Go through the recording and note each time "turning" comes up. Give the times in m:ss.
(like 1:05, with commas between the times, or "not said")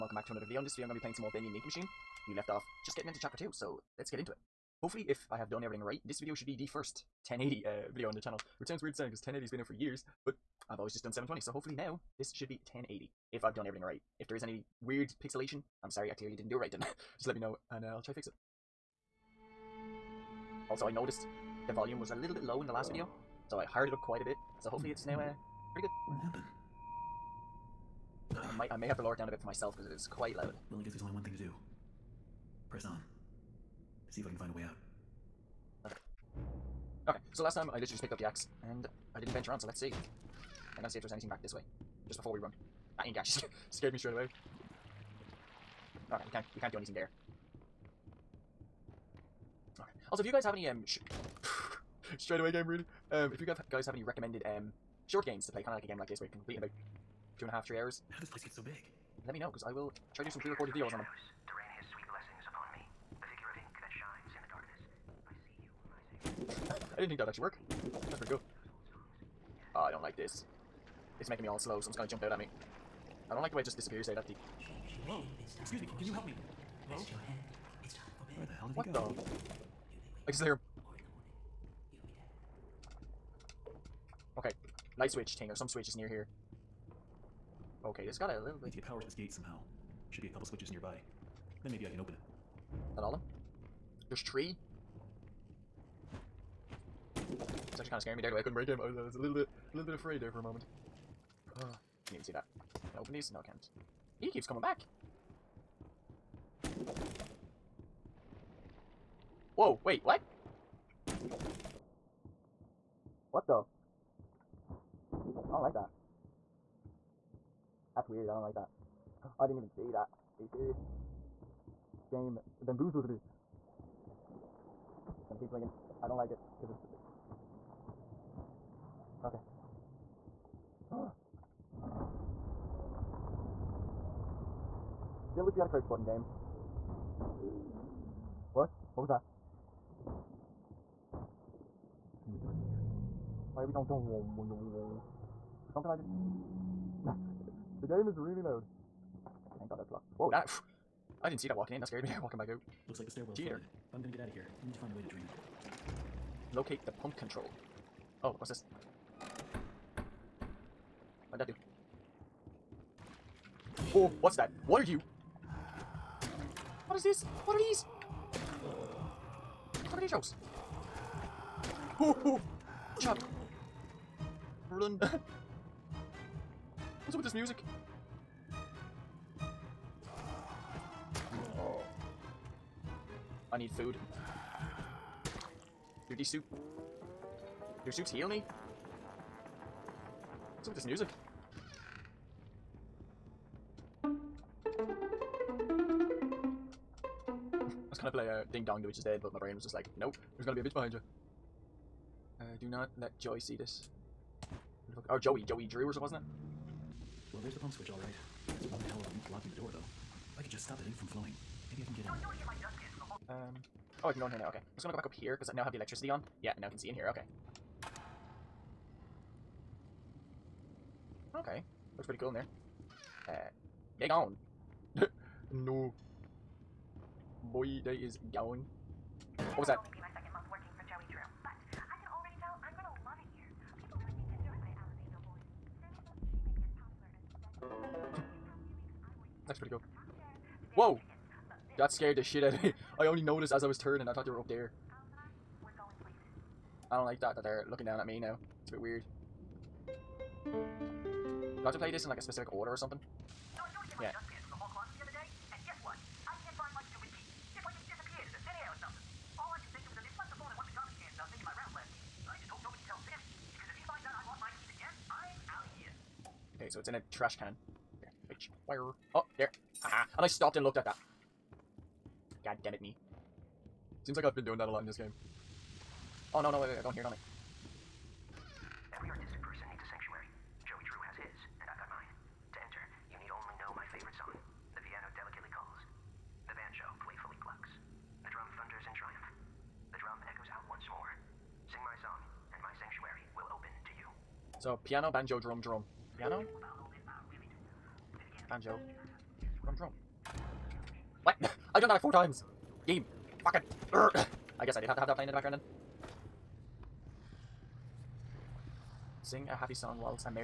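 4:03.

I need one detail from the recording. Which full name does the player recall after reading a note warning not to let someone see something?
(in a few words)
Joey Drew.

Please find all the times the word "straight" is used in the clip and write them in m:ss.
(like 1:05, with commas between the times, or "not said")
0:43, 0:52.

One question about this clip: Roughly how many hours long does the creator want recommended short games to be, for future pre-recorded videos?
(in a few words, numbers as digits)
2 and a half, 3 hours.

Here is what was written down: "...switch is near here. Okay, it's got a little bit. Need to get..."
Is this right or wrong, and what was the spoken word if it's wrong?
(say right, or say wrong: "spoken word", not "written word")
right.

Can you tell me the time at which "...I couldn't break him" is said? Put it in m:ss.
1:38.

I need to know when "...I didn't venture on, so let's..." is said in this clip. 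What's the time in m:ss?
0:39.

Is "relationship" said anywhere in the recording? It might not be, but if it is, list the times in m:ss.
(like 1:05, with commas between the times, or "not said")
not said.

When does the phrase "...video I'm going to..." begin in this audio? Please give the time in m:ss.
0:00.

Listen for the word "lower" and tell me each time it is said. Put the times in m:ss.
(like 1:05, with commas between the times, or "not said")
0:29.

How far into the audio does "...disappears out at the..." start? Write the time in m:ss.
1:13.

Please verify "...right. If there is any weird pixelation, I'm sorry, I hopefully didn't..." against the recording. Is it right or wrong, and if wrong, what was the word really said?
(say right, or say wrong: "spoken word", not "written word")
wrong: "clearly", not "hopefully".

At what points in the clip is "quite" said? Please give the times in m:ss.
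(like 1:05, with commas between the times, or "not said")
0:24, 0:30.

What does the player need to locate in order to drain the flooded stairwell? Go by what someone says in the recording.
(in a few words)
the pump control.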